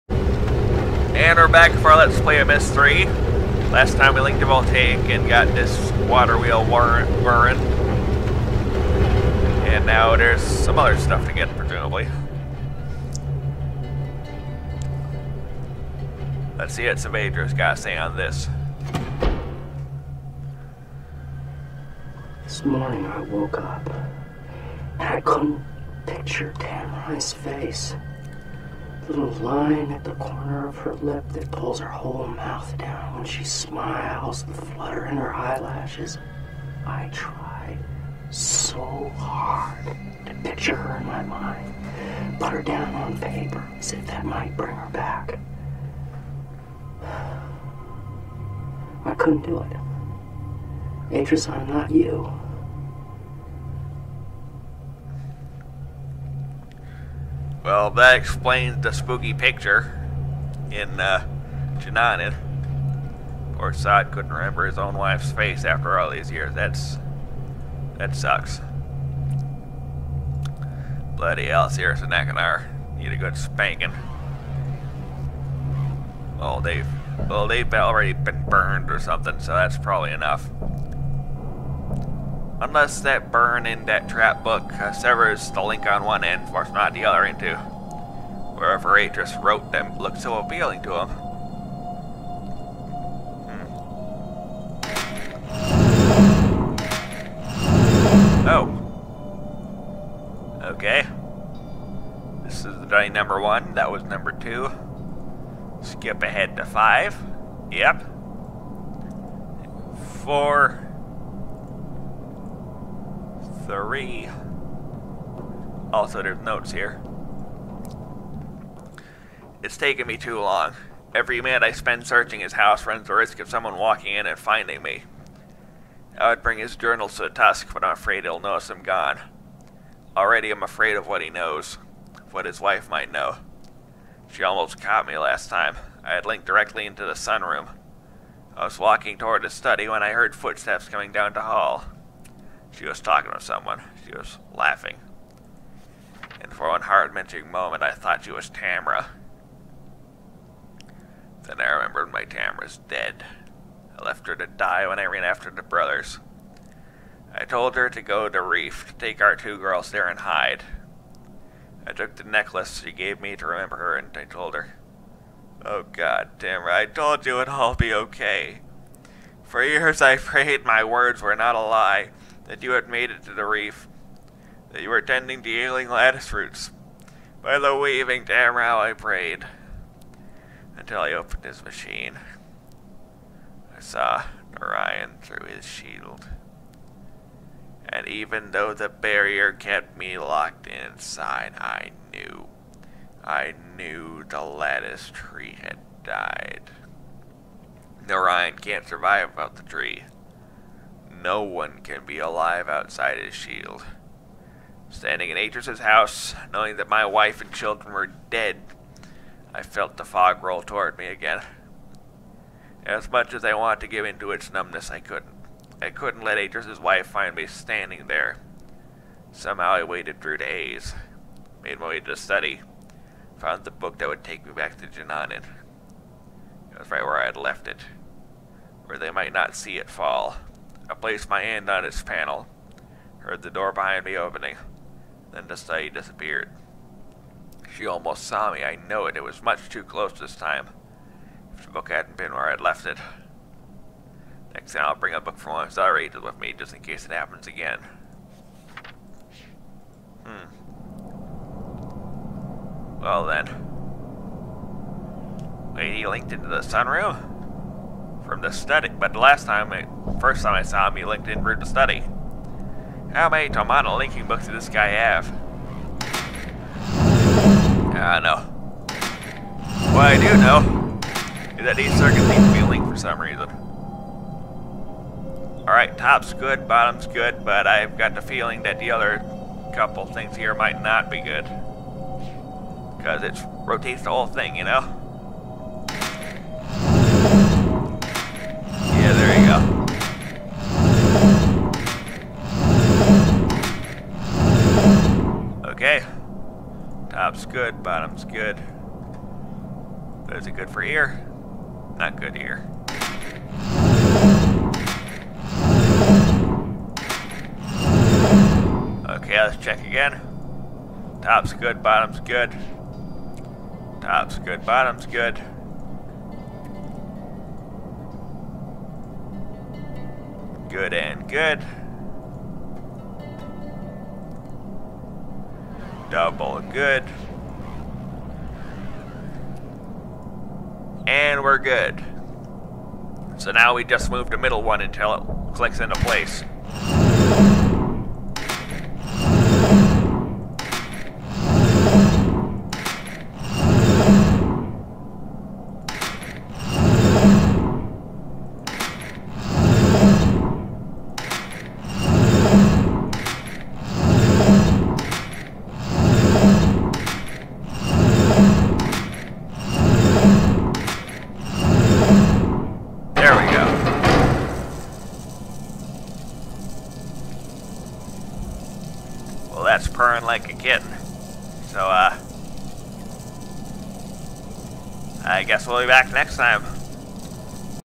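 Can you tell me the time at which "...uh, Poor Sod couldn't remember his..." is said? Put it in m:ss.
1:00.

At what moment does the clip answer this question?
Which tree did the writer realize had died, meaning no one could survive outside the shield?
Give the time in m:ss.
3:14.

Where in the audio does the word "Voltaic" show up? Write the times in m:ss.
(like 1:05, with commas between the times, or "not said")
0:04.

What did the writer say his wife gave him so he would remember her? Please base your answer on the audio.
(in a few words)
necklace.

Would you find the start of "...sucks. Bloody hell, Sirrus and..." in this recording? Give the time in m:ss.
1:08.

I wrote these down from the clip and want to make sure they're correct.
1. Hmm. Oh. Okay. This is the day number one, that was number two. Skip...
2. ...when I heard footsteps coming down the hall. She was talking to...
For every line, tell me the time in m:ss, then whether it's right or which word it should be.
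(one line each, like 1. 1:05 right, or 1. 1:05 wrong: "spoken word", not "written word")
1. 1:34 right
2. 2:19 right.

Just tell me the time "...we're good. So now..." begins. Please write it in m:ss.
5:31.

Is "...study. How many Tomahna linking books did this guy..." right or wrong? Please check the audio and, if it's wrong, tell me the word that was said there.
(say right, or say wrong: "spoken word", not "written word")
right.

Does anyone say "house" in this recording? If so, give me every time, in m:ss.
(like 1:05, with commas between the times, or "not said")
2:02, 3:25.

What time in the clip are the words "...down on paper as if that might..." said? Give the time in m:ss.
0:42.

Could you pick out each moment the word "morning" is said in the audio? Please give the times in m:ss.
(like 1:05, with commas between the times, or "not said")
0:22.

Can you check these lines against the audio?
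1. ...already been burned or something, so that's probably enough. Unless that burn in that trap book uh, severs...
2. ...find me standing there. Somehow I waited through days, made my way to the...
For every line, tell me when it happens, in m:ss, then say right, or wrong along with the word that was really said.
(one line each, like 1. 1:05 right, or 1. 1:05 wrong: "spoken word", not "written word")
1. 1:17 right
2. 3:37 right.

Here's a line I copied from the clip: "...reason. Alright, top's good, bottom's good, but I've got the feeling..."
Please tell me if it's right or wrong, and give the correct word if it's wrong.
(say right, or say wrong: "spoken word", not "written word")
right.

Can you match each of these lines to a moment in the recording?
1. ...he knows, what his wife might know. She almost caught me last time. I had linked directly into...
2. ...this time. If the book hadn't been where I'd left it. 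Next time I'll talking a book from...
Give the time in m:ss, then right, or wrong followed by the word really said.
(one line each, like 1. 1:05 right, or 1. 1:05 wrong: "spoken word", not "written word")
1. 2:11 right
2. 4:00 wrong: "bring", not "talking".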